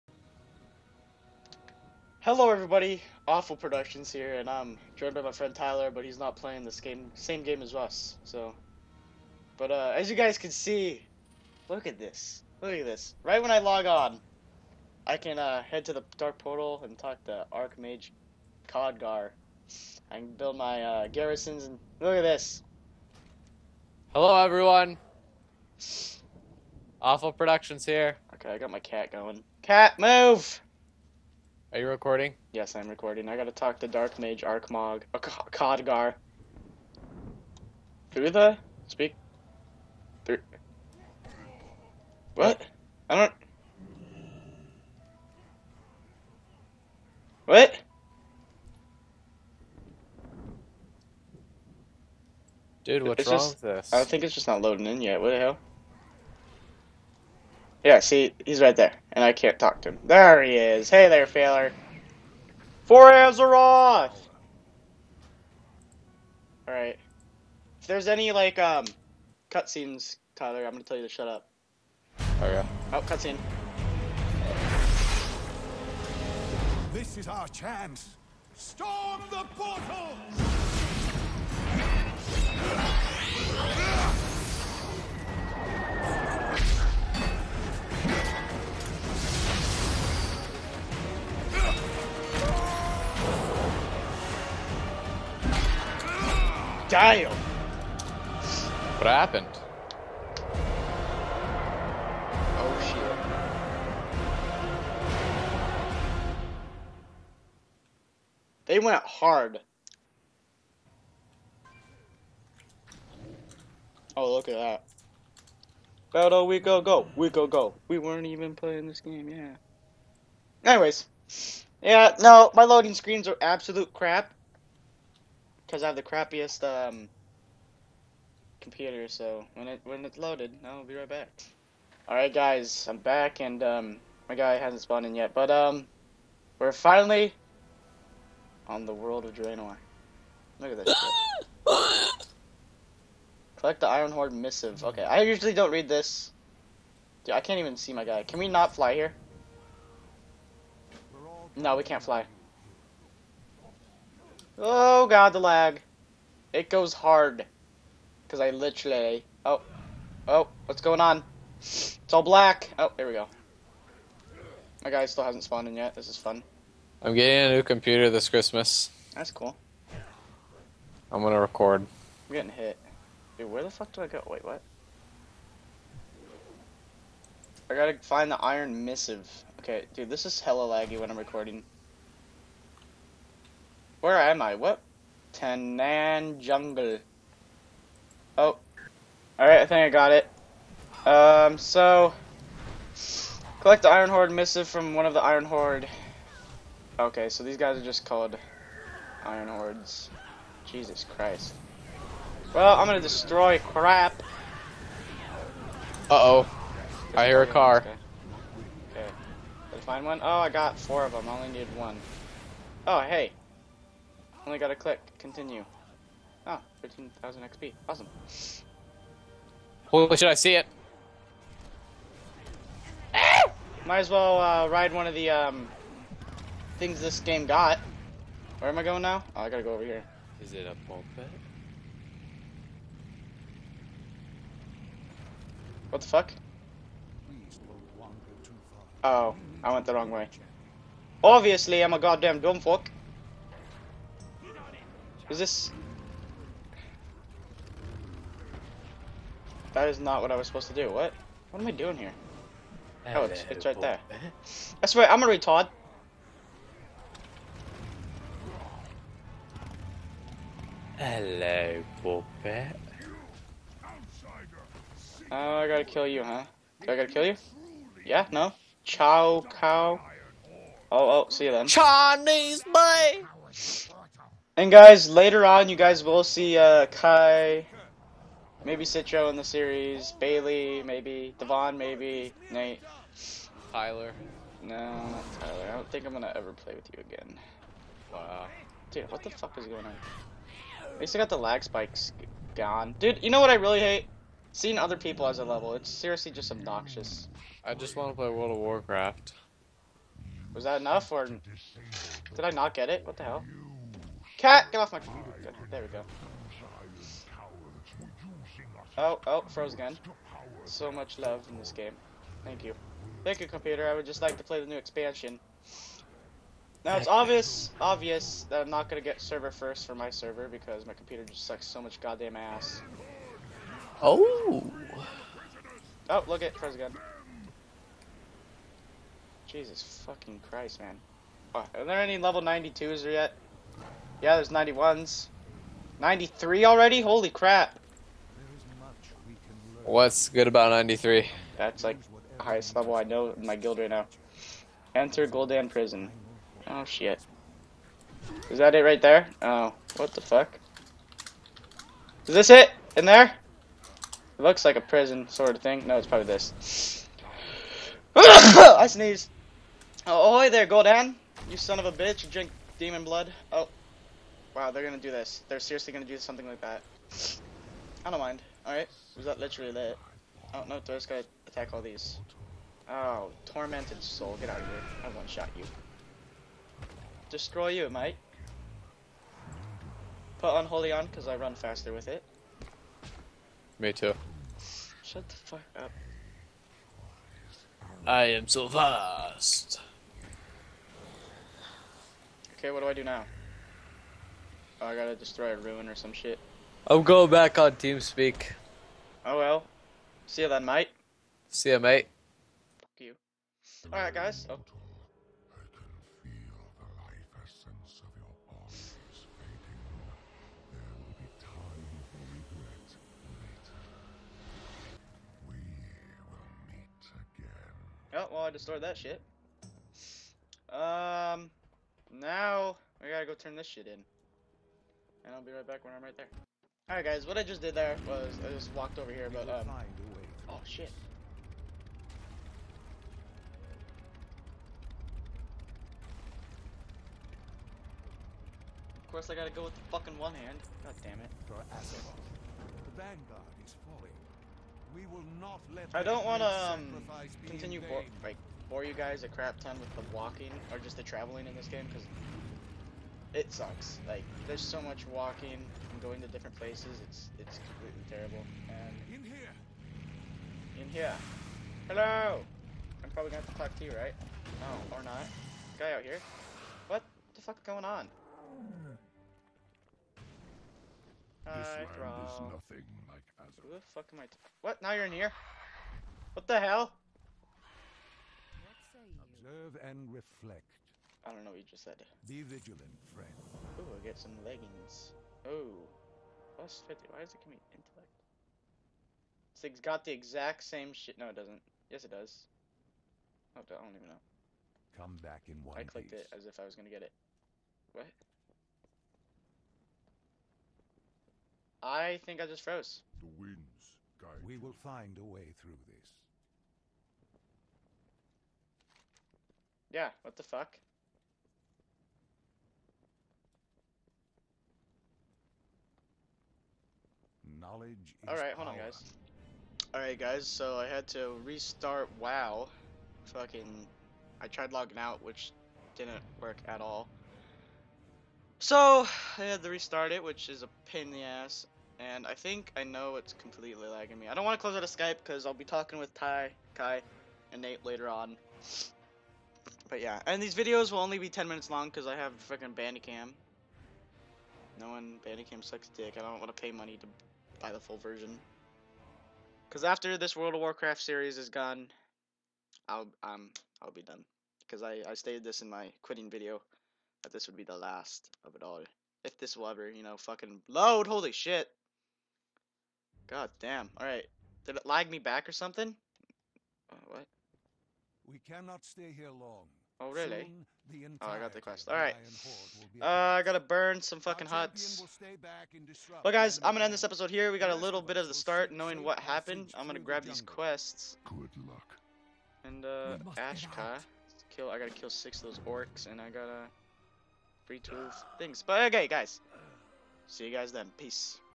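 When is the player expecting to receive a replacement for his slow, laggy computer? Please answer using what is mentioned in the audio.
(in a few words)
Christmas.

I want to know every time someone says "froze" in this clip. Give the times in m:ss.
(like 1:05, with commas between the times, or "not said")
5:09, 5:26, 8:22.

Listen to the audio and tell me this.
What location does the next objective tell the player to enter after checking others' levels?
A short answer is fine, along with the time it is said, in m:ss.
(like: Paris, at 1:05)
Gul'dan Prison, at 5:45.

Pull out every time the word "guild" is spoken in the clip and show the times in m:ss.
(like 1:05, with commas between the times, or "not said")
5:43.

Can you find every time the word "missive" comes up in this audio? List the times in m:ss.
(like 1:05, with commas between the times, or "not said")
2:24, 2:58, 3:14.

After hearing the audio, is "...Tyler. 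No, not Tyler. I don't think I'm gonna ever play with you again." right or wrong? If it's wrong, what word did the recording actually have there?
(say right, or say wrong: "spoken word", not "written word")
right.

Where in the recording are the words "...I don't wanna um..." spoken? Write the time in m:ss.
7:25.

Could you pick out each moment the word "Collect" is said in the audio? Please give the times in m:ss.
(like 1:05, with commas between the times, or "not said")
2:23, 3:13.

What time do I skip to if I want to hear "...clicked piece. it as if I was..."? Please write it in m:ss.
8:15.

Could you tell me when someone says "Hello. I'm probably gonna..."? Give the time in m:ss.
7:41.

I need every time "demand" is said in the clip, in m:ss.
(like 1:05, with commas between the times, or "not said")
not said.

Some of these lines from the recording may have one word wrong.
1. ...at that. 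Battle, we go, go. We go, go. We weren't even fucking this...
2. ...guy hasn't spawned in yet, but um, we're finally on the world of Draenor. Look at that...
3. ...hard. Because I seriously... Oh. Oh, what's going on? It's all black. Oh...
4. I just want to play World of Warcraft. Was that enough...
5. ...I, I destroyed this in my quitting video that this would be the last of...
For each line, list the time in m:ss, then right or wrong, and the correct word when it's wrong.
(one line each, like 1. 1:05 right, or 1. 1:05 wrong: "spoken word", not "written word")
1. 1:54 wrong: "playing", not "fucking"
2. 2:14 right
3. 2:36 wrong: "literally", not "seriously"
4. 4:57 right
5. 9:14 wrong: "stated", not "destroyed".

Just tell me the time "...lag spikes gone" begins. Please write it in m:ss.
4:51.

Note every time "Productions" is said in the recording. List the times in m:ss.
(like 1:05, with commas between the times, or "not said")
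0:03, 0:27.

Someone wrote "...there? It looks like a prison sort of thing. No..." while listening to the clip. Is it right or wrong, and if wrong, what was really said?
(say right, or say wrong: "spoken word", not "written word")
right.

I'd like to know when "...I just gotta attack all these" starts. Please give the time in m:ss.
6:10.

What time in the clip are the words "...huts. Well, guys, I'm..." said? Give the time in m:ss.
9:34.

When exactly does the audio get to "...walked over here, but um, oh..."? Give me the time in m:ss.
7:08.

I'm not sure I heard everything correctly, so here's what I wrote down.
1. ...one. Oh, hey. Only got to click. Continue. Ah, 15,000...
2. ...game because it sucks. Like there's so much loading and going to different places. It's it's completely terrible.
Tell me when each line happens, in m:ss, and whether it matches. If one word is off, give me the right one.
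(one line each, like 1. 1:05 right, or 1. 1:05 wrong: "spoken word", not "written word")
1. 3:31 right
2. 7:31 wrong: "walking", not "loading".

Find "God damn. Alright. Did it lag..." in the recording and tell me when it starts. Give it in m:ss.
9:23.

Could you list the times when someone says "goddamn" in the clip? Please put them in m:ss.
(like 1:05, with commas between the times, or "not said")
4:01, 5:22.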